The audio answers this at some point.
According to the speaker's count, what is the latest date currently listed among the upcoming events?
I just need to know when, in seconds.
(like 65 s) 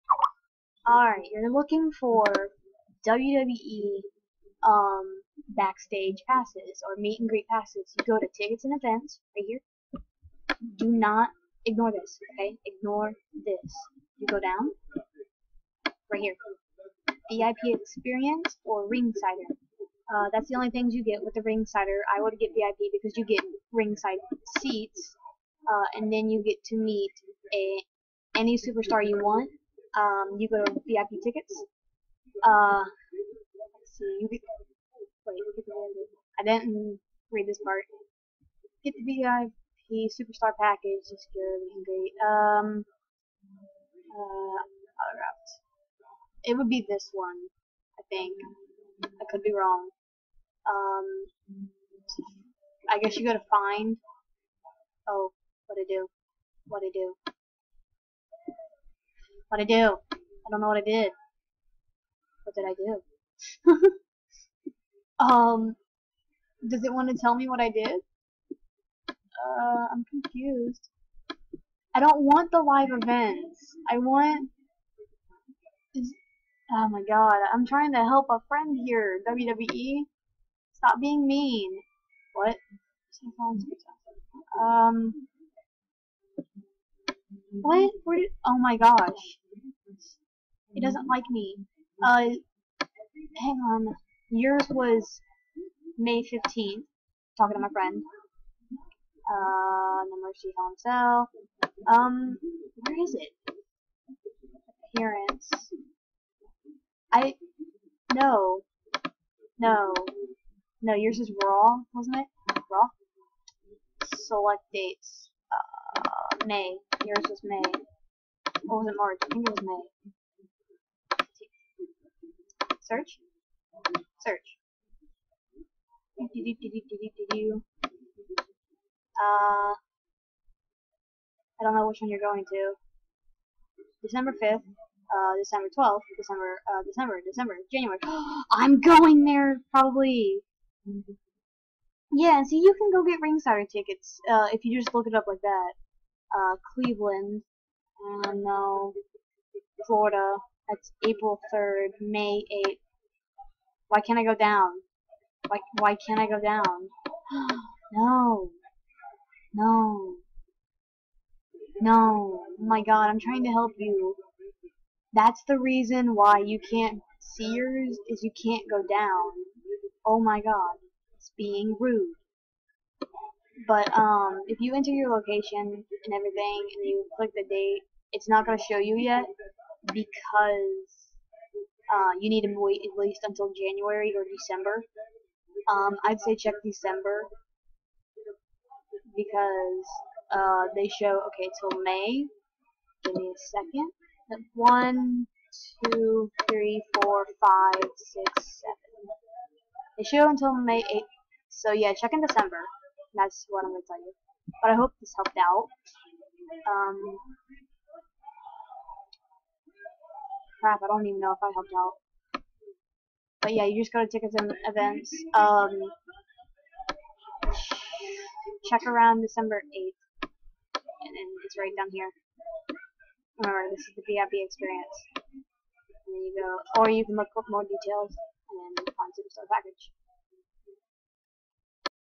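199 s.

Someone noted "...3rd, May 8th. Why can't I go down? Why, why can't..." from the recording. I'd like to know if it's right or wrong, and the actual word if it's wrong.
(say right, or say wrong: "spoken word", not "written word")
right.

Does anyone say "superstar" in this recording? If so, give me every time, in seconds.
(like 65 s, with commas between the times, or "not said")
28 s, 40 s, 229 s.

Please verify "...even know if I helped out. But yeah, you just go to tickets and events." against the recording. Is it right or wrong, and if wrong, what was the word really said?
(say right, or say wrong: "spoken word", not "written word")
right.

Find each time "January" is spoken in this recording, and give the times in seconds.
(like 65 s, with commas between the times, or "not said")
137 s, 183 s.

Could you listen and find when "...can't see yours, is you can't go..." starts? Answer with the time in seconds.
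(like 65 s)
166 s.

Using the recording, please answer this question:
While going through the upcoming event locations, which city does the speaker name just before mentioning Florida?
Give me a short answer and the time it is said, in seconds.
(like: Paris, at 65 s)
Cleveland, at 146 s.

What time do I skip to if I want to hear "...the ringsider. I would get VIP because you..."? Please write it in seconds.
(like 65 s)
21 s.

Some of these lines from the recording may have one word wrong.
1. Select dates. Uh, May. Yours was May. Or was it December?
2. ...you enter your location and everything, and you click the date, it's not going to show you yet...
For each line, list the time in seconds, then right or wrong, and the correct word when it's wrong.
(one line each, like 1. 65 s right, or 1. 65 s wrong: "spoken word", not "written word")
1. 114 s wrong: "March", not "December"
2. 174 s right.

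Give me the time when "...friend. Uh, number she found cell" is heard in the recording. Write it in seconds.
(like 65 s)
97 s.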